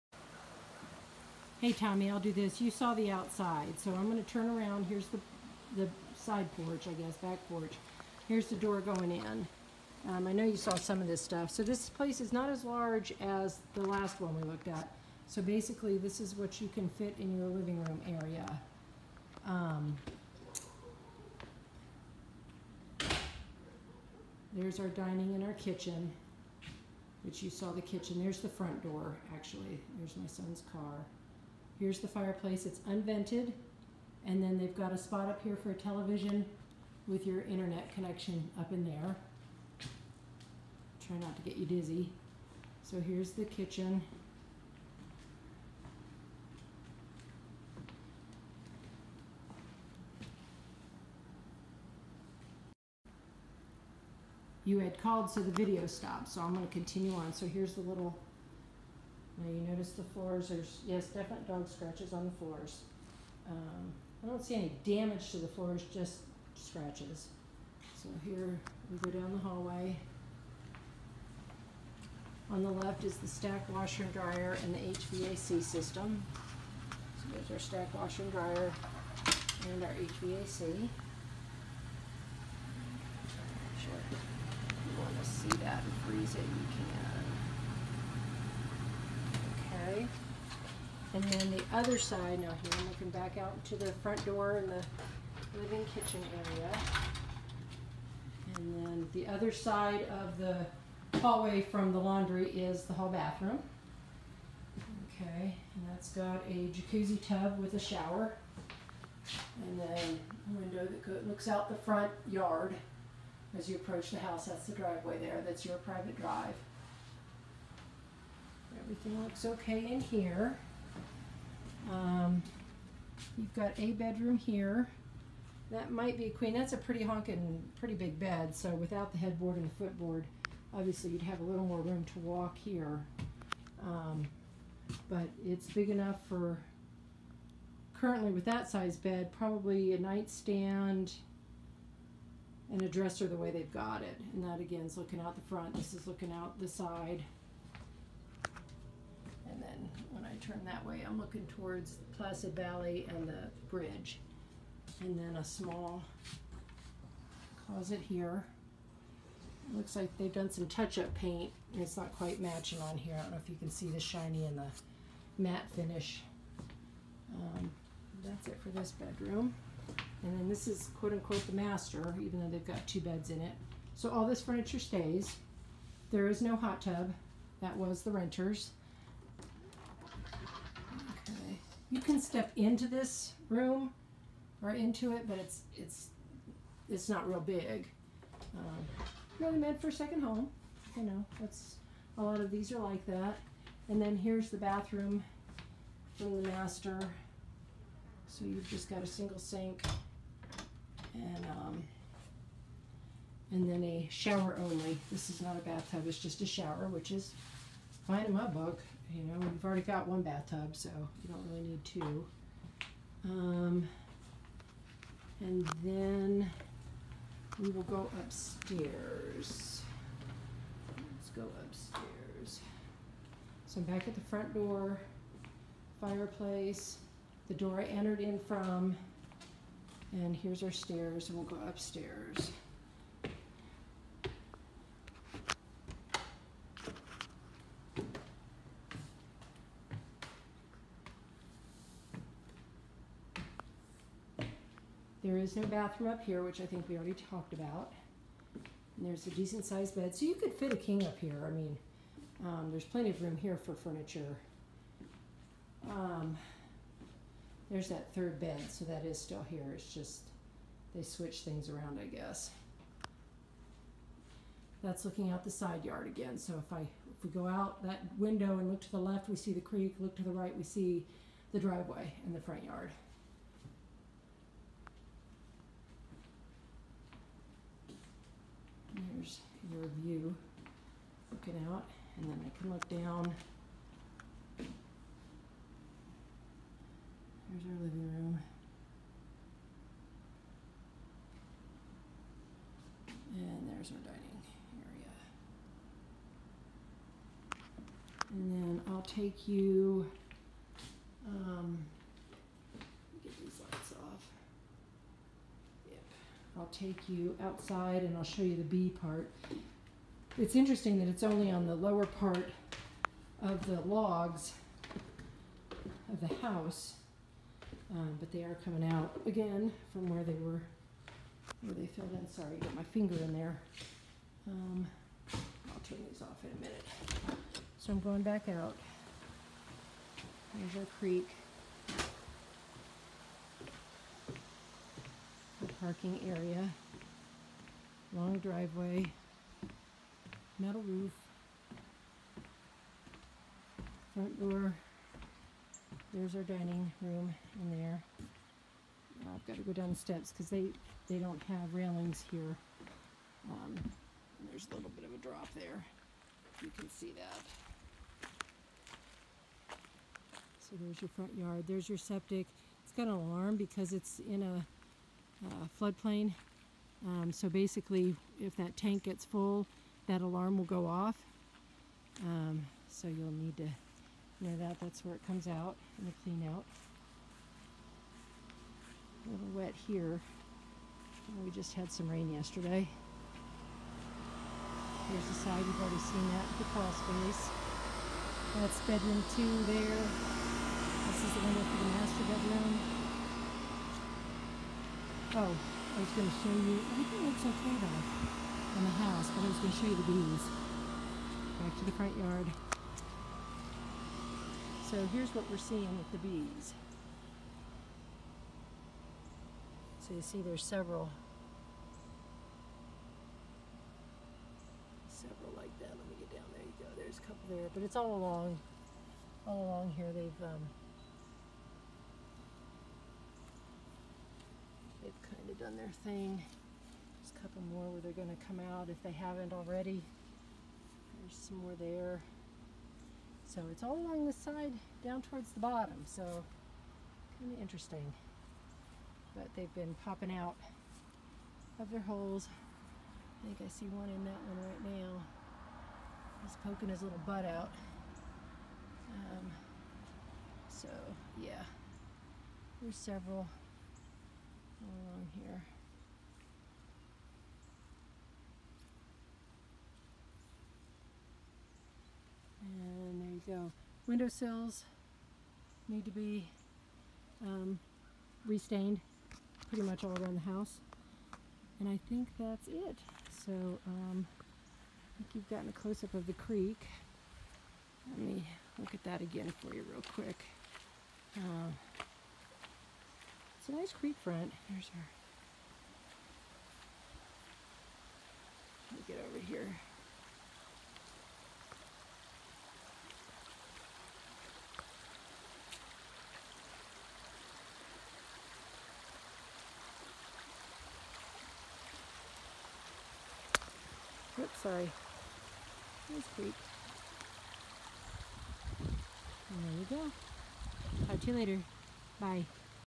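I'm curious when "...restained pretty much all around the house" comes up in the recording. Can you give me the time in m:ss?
7:48.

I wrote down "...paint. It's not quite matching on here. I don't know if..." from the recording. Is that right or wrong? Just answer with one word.
right.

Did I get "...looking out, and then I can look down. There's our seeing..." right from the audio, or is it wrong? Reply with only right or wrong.
wrong.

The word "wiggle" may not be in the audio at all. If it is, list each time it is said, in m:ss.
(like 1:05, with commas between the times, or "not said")
not said.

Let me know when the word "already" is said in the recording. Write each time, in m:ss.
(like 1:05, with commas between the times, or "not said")
3:29, 4:06, 6:25, 7:09.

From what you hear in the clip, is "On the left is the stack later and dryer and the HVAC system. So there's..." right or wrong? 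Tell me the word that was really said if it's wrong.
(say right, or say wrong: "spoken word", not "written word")
wrong: "washer", not "later".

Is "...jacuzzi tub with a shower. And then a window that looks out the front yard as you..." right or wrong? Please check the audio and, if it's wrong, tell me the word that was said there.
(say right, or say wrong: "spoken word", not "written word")
right.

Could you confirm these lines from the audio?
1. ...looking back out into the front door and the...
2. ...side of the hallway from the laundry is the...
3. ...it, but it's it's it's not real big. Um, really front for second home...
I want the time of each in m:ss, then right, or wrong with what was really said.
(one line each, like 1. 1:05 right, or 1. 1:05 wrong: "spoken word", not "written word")
1. 1:32 right
2. 1:39 right
3. 3:05 wrong: "meant", not "front".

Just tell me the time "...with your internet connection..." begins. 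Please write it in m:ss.
0:37.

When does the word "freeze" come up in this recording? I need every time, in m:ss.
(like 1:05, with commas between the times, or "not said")
1:26.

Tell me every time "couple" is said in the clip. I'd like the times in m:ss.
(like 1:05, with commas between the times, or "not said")
6:57, 7:07.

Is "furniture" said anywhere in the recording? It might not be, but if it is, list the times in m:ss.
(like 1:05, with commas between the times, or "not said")
2:54, 4:13.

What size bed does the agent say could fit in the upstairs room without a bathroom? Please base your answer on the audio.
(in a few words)
King.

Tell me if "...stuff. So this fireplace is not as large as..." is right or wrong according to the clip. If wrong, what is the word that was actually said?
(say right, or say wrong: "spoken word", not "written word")
wrong: "place", not "fireplace".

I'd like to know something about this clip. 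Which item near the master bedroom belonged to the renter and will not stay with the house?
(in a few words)
Hot tub.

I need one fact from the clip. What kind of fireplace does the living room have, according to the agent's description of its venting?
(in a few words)
Unvented.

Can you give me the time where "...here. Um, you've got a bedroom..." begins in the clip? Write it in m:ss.
2:00.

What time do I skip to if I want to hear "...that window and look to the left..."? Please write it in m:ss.
4:27.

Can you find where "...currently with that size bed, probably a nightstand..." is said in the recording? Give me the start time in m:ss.
2:17.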